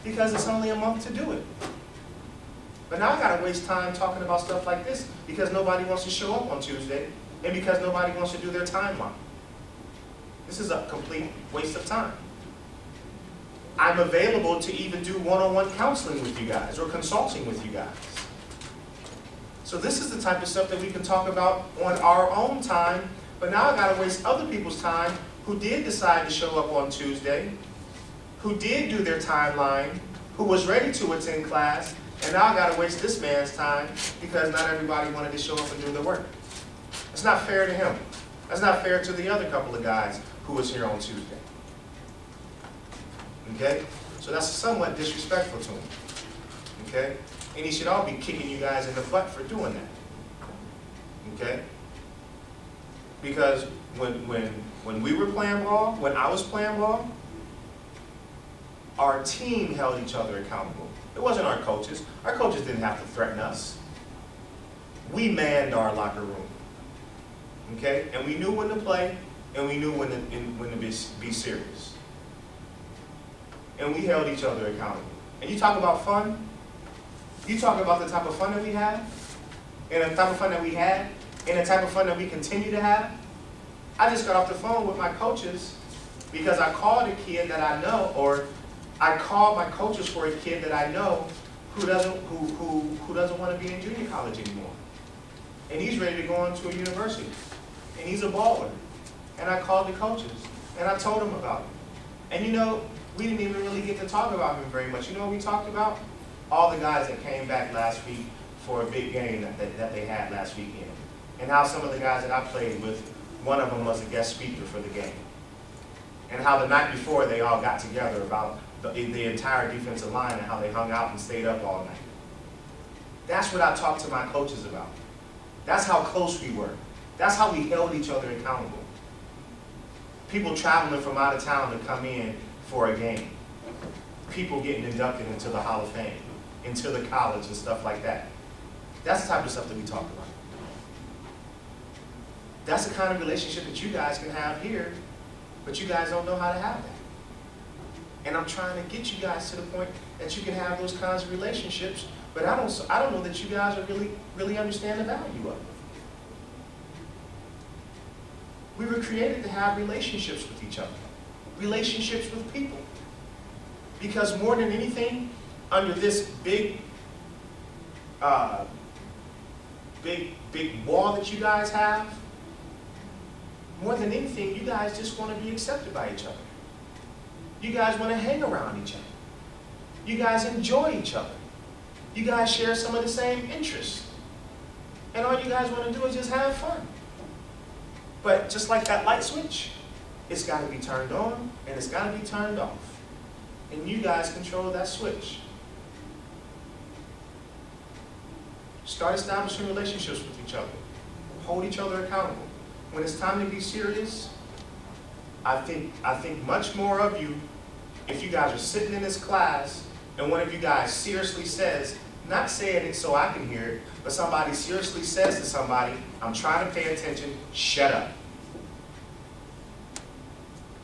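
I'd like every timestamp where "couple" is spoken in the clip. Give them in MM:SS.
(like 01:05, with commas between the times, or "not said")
00:39.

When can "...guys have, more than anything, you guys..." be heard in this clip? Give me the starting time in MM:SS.
02:51.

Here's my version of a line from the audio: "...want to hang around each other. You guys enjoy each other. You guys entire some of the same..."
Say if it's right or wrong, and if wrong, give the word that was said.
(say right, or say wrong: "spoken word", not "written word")
wrong: "share", not "entire".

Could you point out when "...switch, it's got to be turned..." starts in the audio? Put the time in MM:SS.
03:09.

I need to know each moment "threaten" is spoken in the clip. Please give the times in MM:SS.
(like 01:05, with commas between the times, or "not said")
01:03.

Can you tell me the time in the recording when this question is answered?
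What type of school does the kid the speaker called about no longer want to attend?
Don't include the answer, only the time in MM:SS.
01:33.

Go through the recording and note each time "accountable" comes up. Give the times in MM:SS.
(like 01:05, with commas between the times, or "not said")
01:00, 01:14, 02:08, 03:22.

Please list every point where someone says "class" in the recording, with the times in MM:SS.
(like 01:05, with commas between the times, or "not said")
00:31, 03:29.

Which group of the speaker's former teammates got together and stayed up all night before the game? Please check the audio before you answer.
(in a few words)
the entire defensive line.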